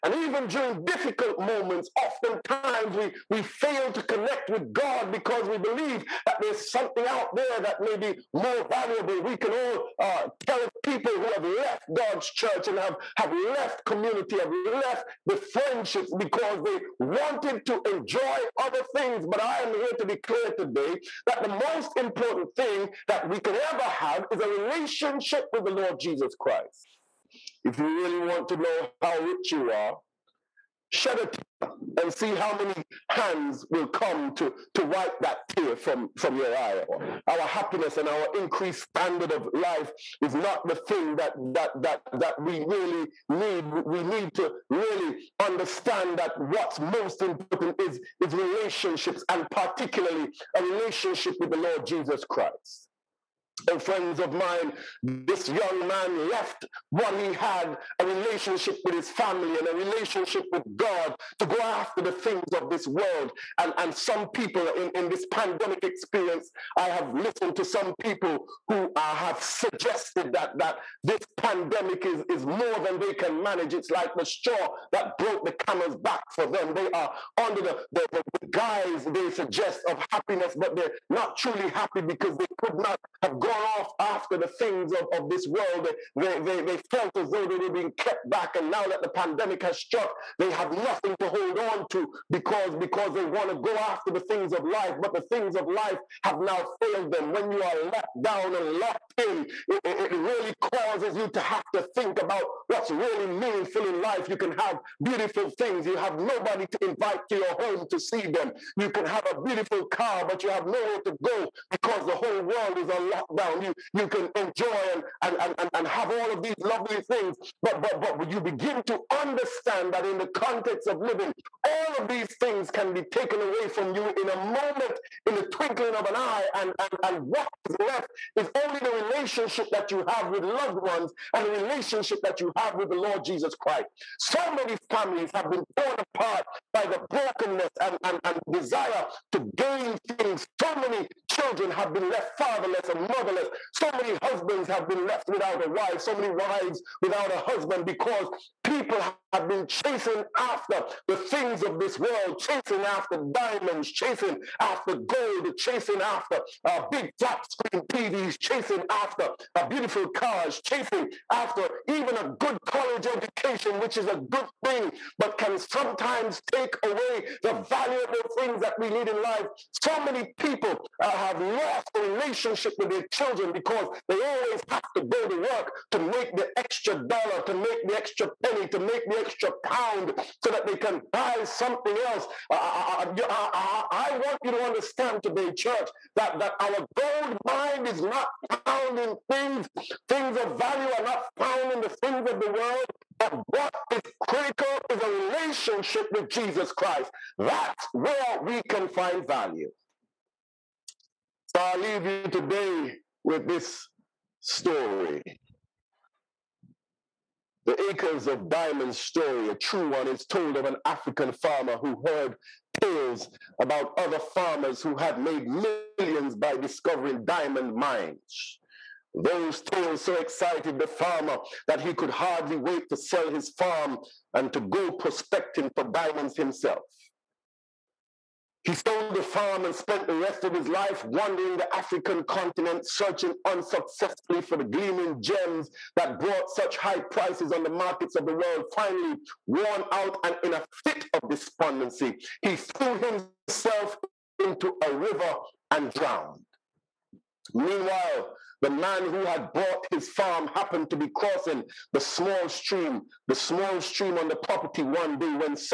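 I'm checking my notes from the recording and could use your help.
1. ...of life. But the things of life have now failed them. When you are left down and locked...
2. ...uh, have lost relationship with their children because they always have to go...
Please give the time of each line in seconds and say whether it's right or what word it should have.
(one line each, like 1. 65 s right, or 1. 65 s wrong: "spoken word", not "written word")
1. 94 s right
2. 171 s right.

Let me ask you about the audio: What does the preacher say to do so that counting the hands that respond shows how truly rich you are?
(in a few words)
Shed a tear.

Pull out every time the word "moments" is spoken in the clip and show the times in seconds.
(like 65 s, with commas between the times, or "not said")
1 s, 124 s.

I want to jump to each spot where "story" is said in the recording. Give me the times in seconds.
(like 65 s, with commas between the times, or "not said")
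204 s, 208 s.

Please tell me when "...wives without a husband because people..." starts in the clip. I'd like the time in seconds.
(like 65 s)
146 s.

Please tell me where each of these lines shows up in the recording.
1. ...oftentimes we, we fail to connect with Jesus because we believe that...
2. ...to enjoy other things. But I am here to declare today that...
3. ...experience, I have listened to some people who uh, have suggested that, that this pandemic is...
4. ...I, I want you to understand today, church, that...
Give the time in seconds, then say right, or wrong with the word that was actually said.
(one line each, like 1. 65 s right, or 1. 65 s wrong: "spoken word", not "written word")
1. 2 s wrong: "God", not "Jesus"
2. 17 s right
3. 65 s right
4. 183 s right.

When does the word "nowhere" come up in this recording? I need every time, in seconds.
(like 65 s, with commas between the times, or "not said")
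110 s.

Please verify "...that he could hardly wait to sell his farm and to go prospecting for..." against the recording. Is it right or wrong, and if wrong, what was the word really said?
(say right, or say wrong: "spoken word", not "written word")
right.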